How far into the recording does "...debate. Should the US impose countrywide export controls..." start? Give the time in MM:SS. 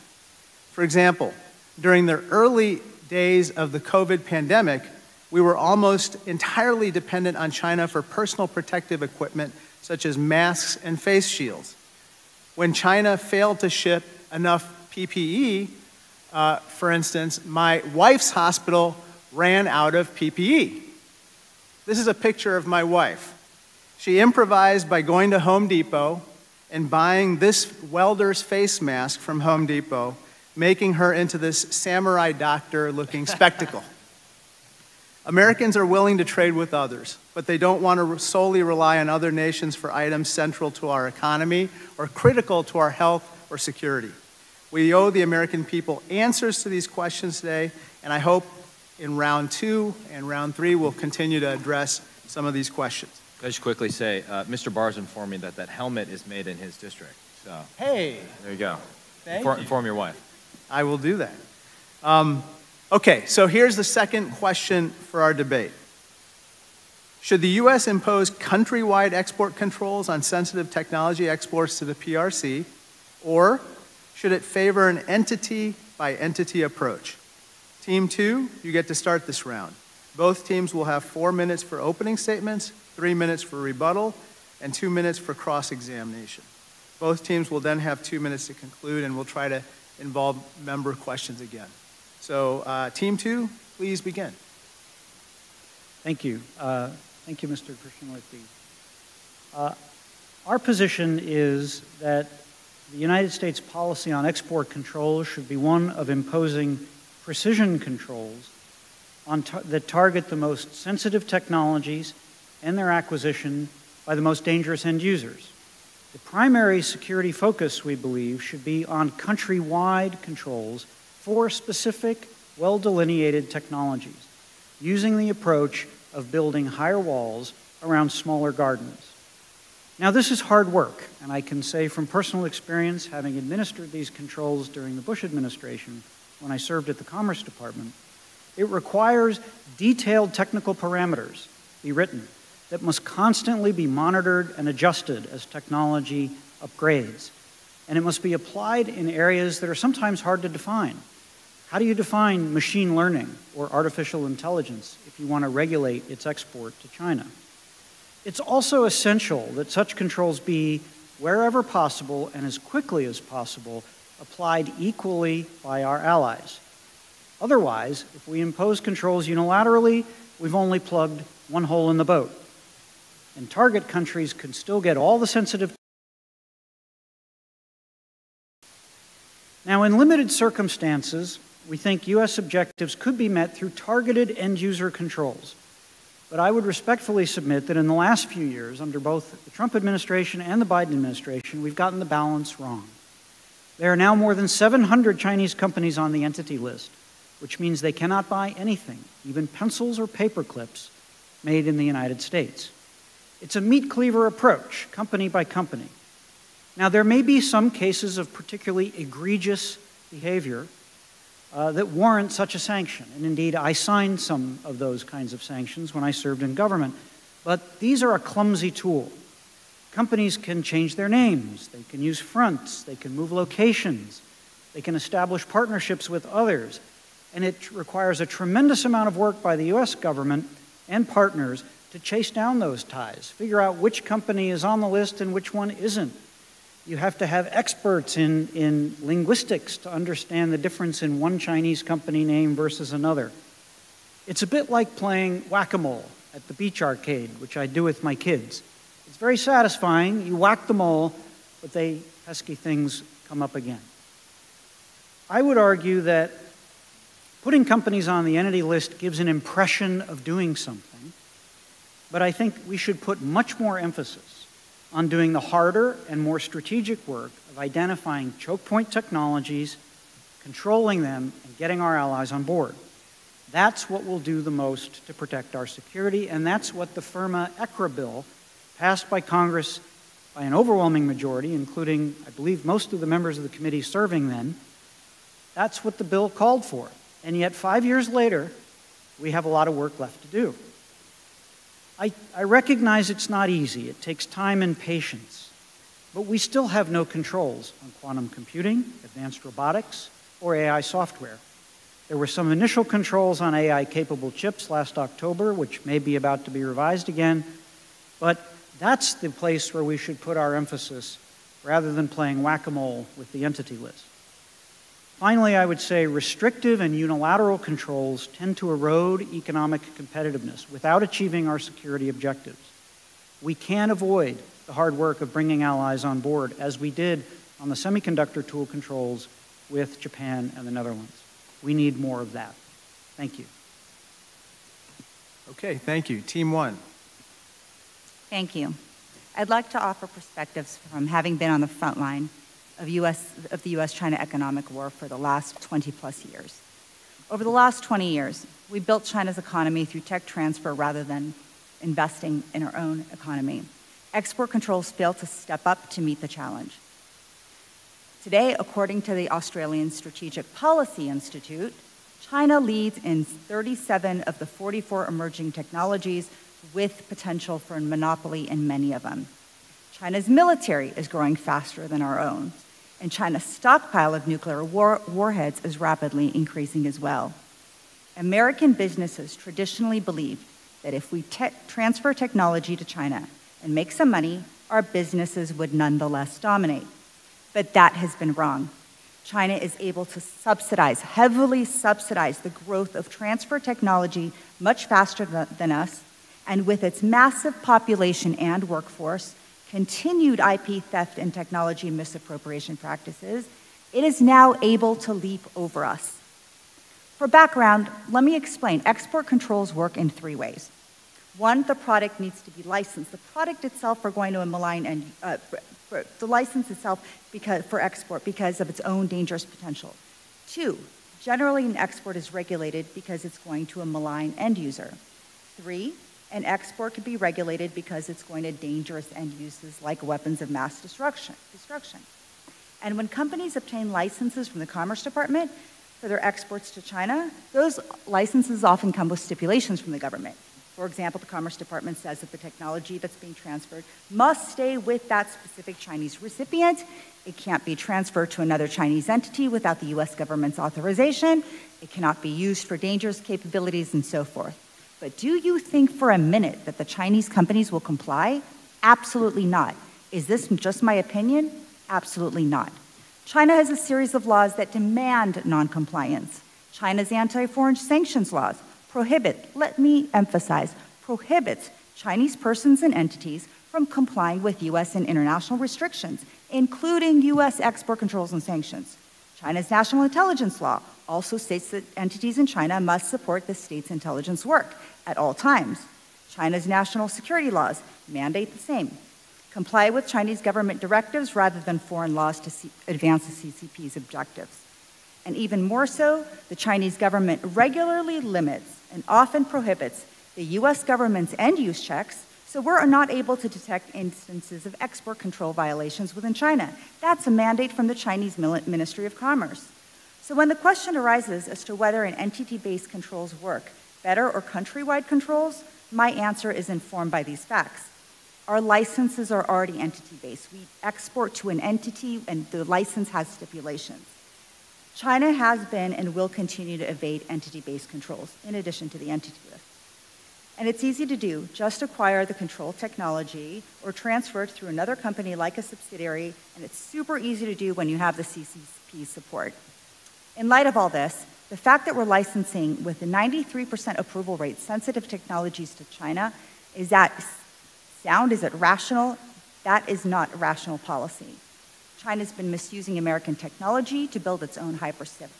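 01:05.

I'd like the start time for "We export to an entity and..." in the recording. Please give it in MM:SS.
08:40.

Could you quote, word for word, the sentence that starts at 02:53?
And target countries can still get all the sensitive.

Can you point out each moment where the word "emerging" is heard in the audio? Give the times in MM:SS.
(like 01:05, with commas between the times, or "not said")
06:05.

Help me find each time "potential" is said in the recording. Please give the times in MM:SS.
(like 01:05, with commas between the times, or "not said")
06:07, 06:59.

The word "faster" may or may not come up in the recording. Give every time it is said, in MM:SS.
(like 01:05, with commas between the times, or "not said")
06:11, 06:34.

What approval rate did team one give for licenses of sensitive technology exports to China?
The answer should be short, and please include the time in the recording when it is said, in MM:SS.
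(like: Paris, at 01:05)
93%, at 09:03.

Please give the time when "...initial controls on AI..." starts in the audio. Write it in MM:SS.
05:02.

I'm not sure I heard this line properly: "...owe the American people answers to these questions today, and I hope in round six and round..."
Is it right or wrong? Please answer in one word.
wrong.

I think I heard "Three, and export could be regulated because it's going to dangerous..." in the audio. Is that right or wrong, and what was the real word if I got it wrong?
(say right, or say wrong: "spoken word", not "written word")
right.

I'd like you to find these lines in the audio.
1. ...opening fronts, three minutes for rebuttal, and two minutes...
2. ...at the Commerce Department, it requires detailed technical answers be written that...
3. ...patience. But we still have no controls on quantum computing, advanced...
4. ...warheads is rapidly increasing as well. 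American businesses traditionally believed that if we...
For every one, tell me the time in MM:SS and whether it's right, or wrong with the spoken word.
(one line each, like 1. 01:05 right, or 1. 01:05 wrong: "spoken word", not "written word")
1. 01:21 wrong: "statements", not "fronts"
2. 02:16 wrong: "parameters", not "answers"
3. 04:54 right
4. 06:15 right.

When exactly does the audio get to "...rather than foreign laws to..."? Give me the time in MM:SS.
08:11.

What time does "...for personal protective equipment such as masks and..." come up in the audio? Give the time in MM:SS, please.
00:07.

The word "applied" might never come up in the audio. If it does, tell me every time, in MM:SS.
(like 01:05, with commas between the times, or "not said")
02:28, 02:44.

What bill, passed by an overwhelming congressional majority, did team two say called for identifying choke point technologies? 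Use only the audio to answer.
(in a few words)
FIRRMA ECRA.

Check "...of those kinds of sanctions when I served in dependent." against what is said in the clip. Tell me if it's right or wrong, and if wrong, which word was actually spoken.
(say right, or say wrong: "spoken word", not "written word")
wrong: "government", not "dependent".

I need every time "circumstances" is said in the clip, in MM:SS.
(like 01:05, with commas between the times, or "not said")
03:00.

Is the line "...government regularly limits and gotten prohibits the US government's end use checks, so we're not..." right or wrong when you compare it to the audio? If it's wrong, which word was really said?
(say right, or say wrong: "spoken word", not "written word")
wrong: "often", not "gotten".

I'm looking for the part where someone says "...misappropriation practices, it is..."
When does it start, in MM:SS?
06:41.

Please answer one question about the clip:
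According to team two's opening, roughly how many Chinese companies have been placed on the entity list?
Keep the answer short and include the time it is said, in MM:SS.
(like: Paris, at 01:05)
more than 700, at 03:14.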